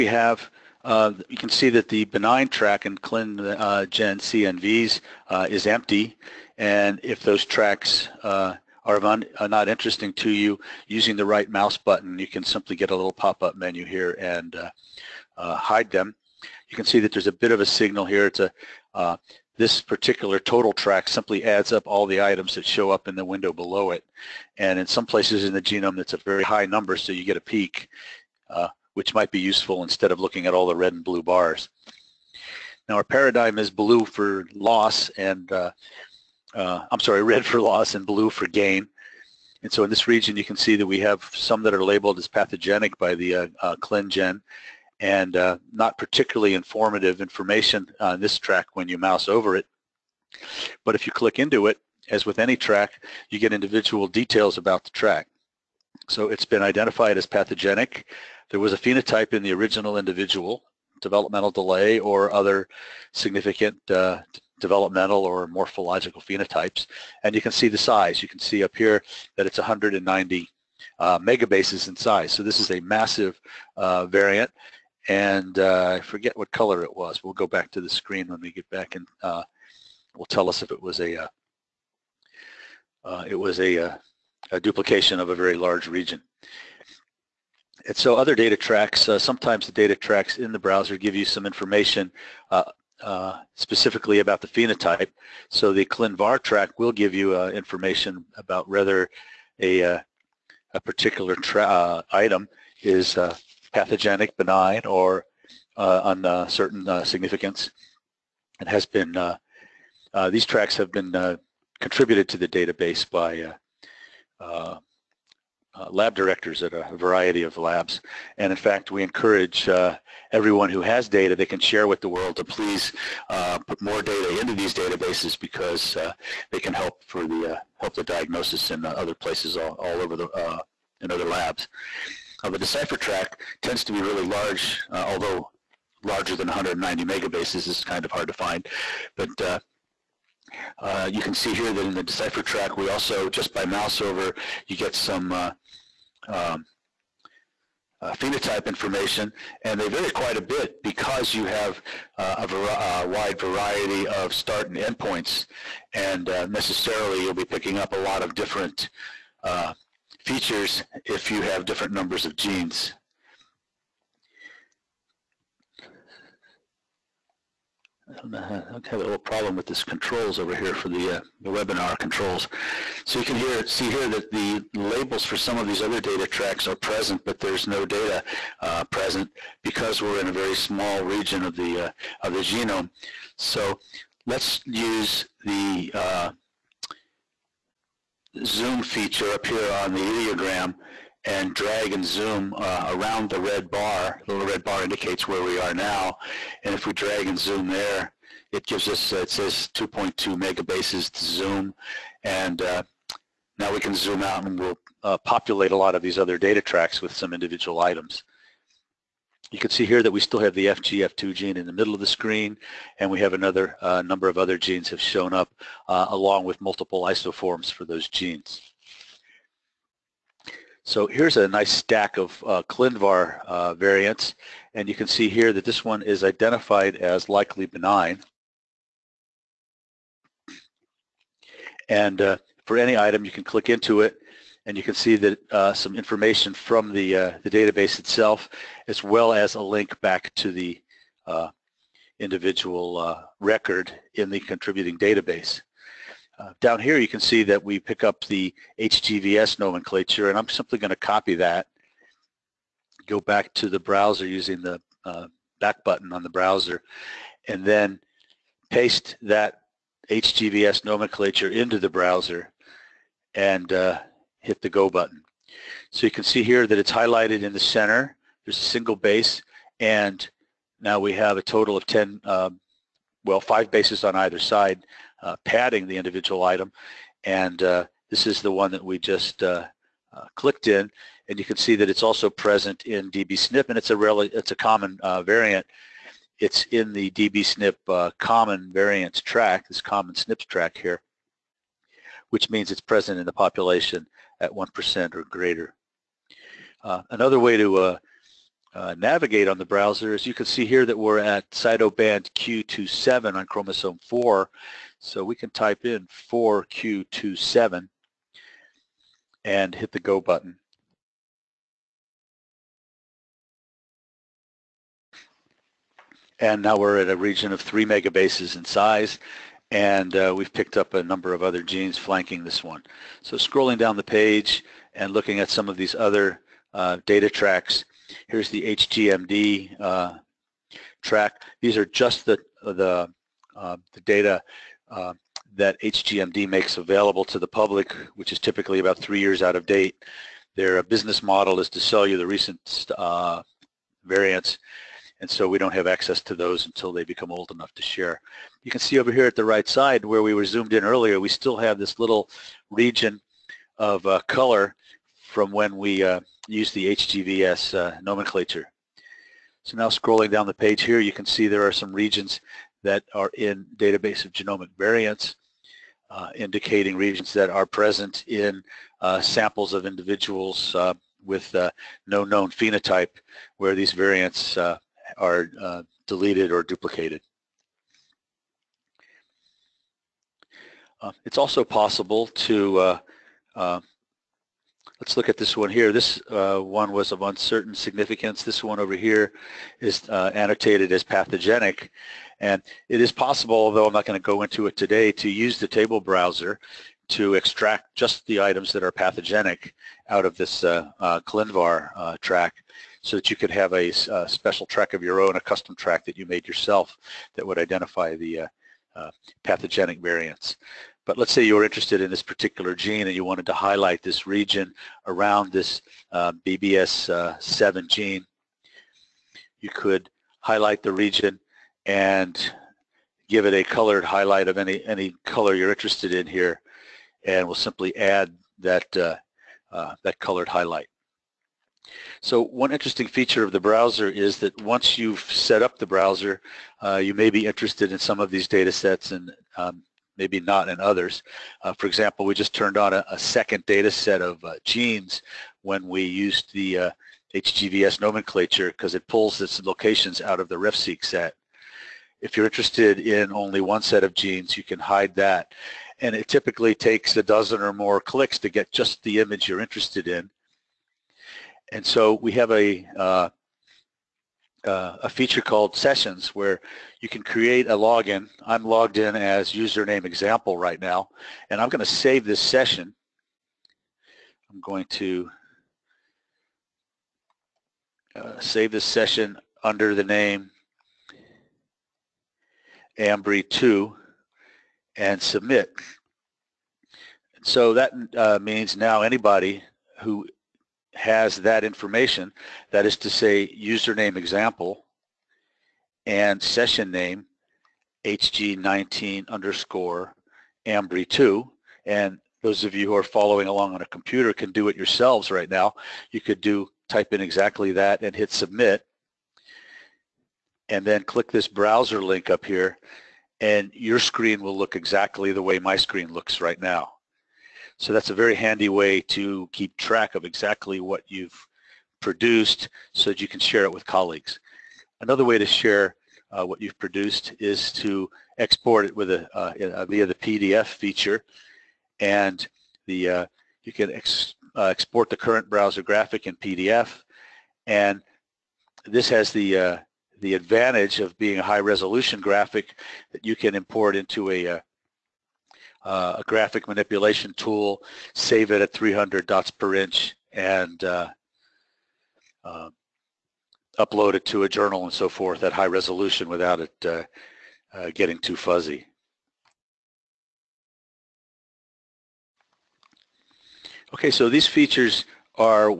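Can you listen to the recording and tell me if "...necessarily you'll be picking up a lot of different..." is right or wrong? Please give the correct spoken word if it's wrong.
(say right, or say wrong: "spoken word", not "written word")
right.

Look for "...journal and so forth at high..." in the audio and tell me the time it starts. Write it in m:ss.
9:14.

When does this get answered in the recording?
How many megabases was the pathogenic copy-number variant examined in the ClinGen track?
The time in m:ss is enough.
1:09.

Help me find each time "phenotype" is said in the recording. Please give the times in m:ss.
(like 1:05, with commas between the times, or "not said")
0:58, 1:06, 1:34, 2:28, 6:12.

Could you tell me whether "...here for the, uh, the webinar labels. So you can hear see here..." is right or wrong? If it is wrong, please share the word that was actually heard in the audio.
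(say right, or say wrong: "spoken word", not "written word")
wrong: "controls", not "labels".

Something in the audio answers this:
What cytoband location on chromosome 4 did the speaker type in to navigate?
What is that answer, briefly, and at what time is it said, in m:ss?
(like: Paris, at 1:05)
4q27, at 5:06.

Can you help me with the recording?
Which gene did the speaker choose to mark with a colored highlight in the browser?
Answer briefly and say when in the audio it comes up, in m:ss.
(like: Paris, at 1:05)
BBS7, at 6:56.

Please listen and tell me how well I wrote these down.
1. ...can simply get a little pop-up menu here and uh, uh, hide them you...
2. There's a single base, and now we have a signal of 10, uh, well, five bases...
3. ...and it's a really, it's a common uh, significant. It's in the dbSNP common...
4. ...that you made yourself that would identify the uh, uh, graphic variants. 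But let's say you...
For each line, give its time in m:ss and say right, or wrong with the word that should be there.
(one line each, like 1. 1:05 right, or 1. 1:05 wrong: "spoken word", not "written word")
1. 0:12 right
2. 4:28 wrong: "total", not "signal"
3. 4:43 wrong: "variant", not "significant"
4. 6:46 wrong: "pathogenic", not "graphic".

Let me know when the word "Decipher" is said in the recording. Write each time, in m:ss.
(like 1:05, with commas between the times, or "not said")
2:12, 2:22.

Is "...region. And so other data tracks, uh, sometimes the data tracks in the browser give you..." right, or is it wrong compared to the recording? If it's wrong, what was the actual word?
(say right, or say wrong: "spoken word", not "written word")
right.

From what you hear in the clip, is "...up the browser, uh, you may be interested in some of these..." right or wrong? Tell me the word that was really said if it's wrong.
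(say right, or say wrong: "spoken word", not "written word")
right.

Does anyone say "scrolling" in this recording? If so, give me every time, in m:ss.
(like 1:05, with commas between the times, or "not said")
5:23, 5:59.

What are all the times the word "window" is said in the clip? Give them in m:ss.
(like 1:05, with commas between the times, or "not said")
0:23.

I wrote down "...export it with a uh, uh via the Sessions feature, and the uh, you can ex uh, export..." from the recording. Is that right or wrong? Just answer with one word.
wrong.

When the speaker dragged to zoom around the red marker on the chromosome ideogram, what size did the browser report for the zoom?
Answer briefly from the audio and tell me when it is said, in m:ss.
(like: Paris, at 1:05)
2.2 megabases, at 3:19.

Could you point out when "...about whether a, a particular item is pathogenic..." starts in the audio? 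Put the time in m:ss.
1:38.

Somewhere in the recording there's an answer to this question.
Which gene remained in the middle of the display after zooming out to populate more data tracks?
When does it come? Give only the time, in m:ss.
3:30.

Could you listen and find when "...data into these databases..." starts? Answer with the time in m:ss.
2:04.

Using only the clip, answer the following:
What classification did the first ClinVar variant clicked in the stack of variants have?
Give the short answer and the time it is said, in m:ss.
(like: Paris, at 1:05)
likely benign, at 3:47.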